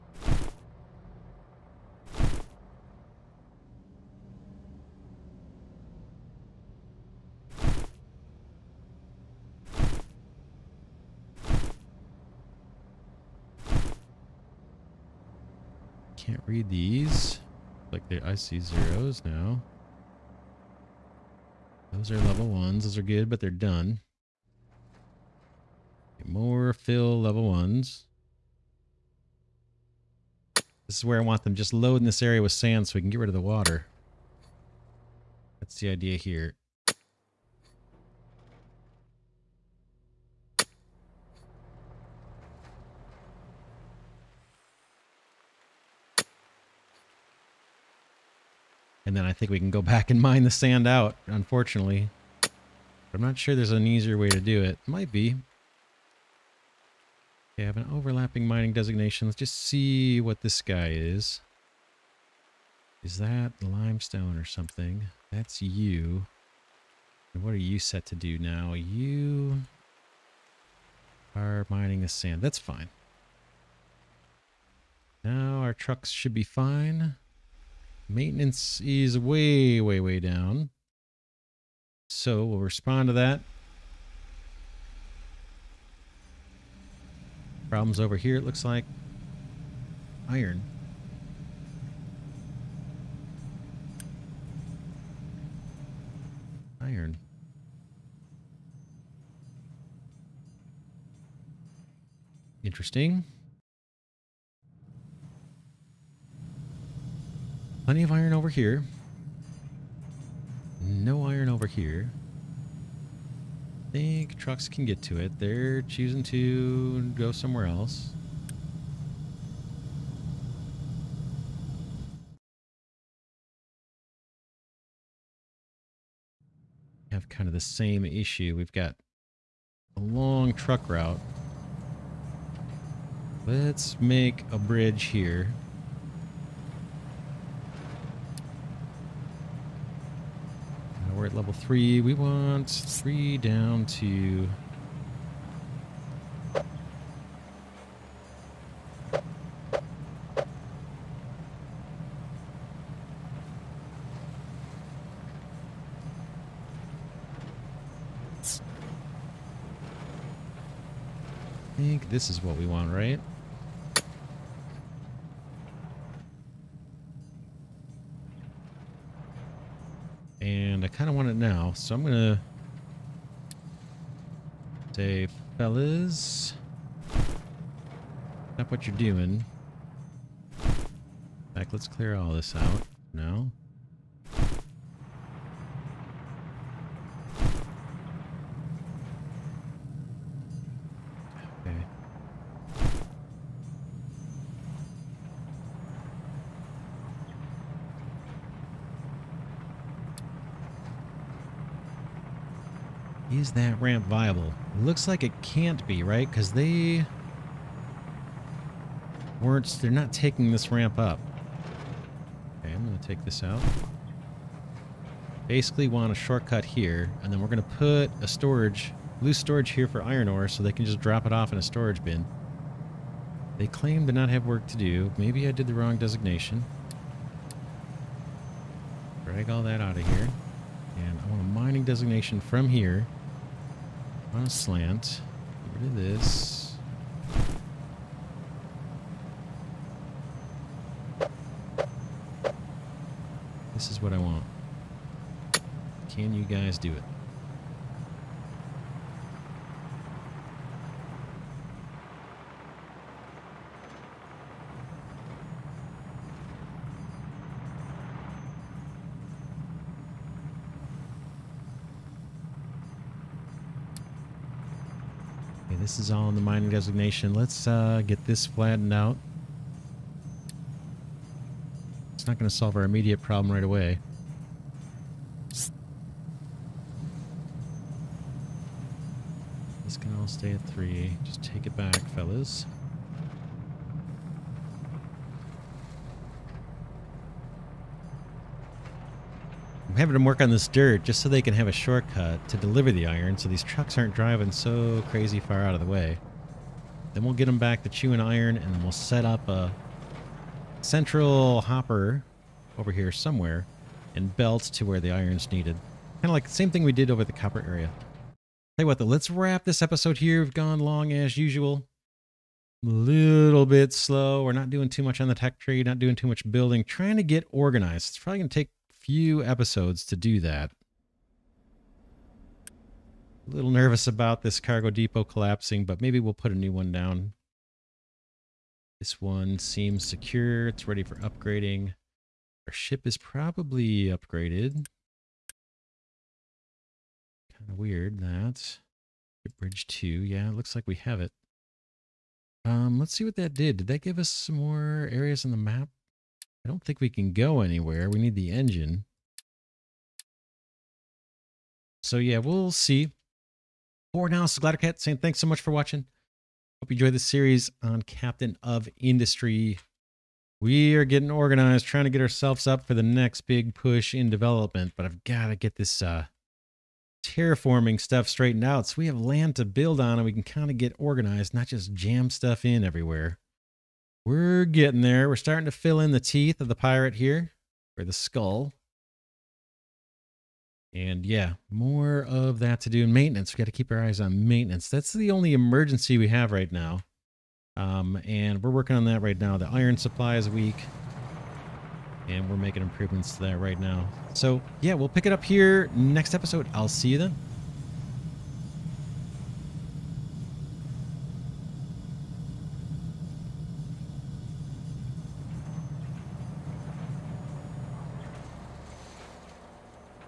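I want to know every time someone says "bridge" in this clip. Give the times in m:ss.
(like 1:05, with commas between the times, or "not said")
2:14, 5:39.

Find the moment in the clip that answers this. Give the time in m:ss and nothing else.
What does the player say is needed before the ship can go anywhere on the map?
5:48.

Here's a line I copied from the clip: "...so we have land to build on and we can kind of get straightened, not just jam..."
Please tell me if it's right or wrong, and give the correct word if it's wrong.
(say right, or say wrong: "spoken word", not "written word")
wrong: "organized", not "straightened".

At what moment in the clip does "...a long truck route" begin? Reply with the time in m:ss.
2:09.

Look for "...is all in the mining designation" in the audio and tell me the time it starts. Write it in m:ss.
4:26.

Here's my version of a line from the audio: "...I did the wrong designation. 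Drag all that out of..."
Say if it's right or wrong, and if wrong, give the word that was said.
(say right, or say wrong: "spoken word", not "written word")
right.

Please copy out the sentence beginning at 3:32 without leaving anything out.
Okay, I'm going to take this out.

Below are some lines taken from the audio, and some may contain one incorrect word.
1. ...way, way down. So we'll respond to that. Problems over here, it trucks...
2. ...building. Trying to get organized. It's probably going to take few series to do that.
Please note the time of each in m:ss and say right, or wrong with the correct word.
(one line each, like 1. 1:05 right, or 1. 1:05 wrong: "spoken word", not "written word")
1. 1:19 wrong: "looks", not "trucks"
2. 5:16 wrong: "episodes", not "series".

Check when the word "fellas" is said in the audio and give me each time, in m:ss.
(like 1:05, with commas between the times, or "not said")
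2:55, 4:42.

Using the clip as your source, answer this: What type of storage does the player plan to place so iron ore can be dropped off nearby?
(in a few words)
loose storage.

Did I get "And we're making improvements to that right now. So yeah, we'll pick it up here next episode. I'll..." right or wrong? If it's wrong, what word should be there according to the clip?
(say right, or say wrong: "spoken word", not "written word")
right.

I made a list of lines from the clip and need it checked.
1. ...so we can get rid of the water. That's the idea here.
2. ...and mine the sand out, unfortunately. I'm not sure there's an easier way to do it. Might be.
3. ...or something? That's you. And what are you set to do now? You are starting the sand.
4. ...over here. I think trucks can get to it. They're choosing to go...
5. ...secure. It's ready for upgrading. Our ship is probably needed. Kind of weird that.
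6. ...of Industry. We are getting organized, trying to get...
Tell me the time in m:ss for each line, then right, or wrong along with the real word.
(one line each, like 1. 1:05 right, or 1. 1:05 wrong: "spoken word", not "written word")
1. 0:32 right
2. 0:50 right
3. 1:04 wrong: "mining", not "starting"
4. 1:51 right
5. 5:30 wrong: "upgraded", not "needed"
6. 5:58 right.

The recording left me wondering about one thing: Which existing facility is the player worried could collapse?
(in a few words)
cargo depot.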